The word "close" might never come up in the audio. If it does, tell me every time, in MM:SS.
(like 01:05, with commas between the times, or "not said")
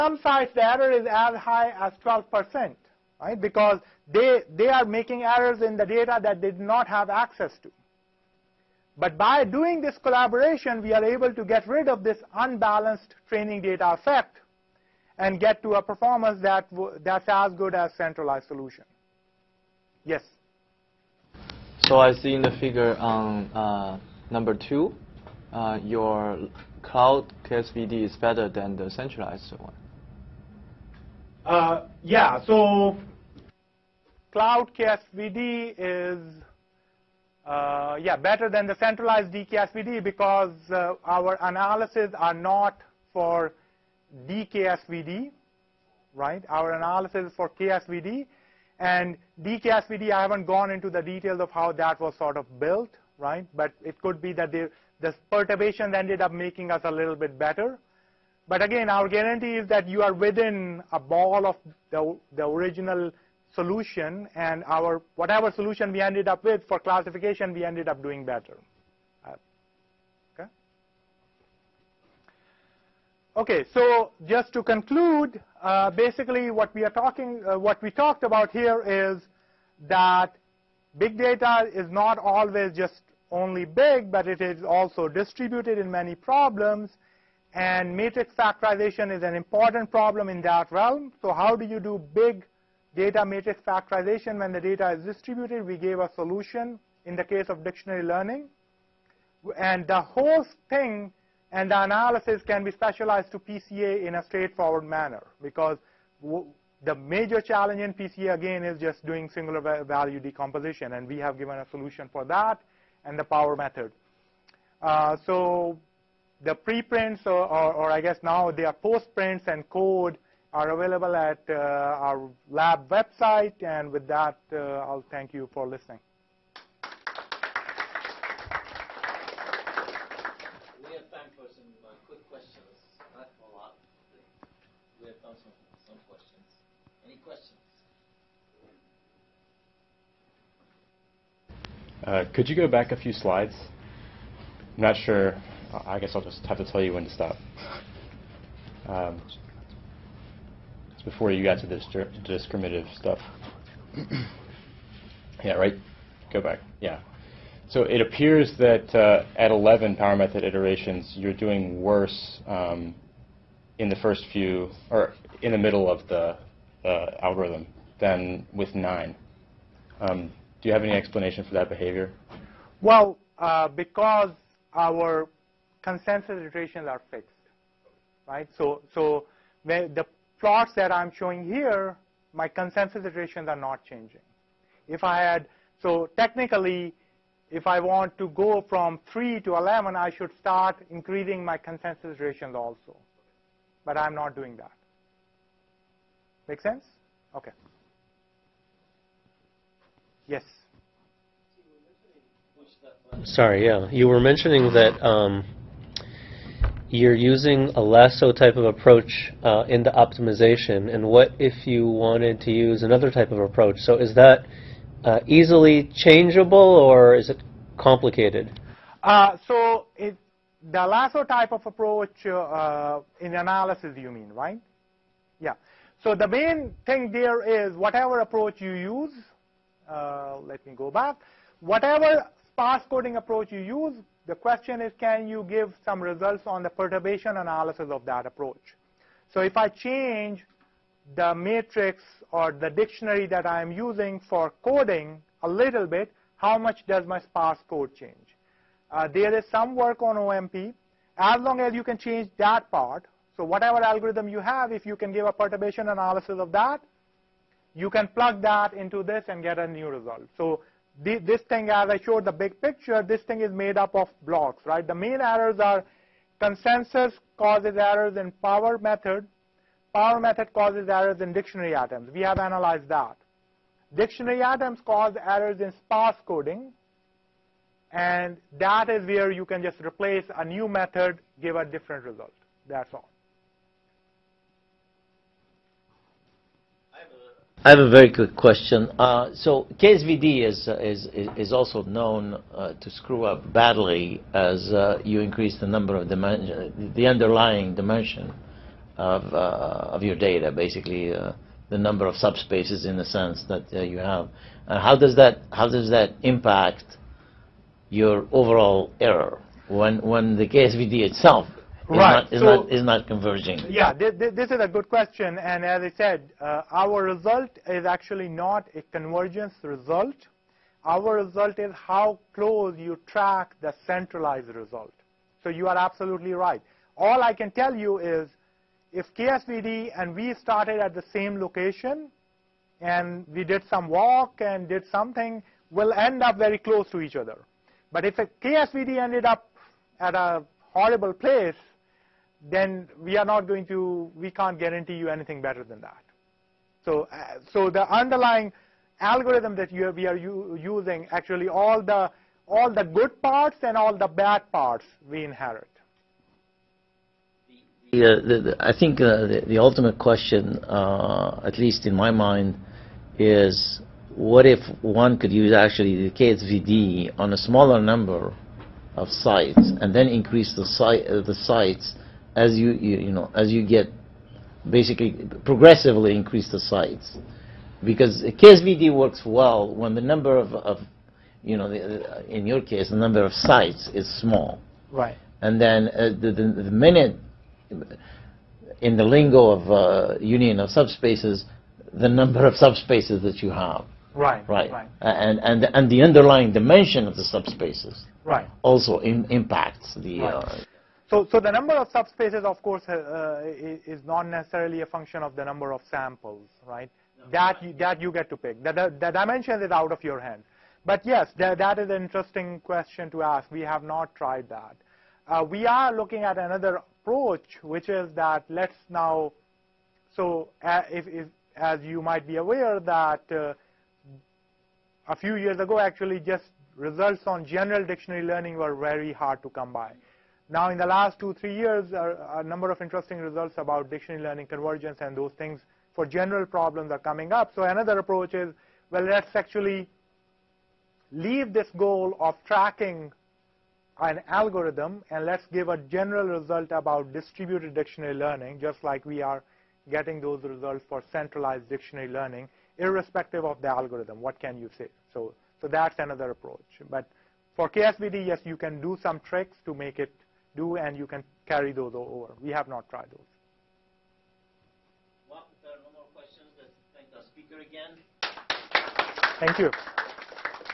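05:22, 05:36.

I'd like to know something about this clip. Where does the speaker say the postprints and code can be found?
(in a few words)
lab website.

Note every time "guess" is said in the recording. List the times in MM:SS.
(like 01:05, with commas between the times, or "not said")
01:58, 02:25.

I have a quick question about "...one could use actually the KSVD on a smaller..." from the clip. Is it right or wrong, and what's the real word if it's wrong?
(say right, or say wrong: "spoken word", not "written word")
right.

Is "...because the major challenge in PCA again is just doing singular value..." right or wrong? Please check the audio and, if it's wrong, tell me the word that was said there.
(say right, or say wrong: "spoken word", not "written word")
right.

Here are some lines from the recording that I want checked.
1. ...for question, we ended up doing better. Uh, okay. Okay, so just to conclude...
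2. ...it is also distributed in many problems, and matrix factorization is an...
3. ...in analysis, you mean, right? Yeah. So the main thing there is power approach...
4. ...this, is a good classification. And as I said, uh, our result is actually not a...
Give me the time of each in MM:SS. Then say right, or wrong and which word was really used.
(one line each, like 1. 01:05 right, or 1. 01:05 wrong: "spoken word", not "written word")
1. 01:06 wrong: "classification", not "question"
2. 01:24 right
3. 03:43 wrong: "whatever", not "power"
4. 05:14 wrong: "question", not "classification".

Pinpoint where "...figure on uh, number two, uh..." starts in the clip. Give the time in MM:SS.
00:22.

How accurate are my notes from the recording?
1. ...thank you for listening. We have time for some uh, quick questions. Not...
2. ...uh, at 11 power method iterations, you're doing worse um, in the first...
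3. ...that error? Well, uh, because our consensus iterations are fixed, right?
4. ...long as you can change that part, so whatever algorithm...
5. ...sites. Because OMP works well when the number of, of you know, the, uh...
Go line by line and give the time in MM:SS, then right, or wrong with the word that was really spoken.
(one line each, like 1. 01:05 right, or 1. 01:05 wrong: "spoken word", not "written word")
1. 02:05 right
2. 02:38 right
3. 02:51 wrong: "behavior", not "error"
4. 04:11 right
5. 06:16 wrong: "KSVD", not "OMP".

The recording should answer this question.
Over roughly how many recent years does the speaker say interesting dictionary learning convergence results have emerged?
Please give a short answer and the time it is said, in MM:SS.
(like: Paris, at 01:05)
2 or 3 years, at 07:11.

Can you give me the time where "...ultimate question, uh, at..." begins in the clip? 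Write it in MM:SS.
05:59.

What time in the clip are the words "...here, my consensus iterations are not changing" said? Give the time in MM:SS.
03:01.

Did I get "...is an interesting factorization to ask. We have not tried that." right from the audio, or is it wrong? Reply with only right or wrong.
wrong.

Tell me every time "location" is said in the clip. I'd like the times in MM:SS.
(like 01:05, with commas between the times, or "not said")
05:31.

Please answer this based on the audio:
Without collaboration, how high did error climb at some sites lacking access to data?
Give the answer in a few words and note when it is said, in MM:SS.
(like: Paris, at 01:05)
12 percent, at 00:02.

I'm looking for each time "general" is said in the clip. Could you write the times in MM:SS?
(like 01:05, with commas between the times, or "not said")
07:07, 07:16, 07:25.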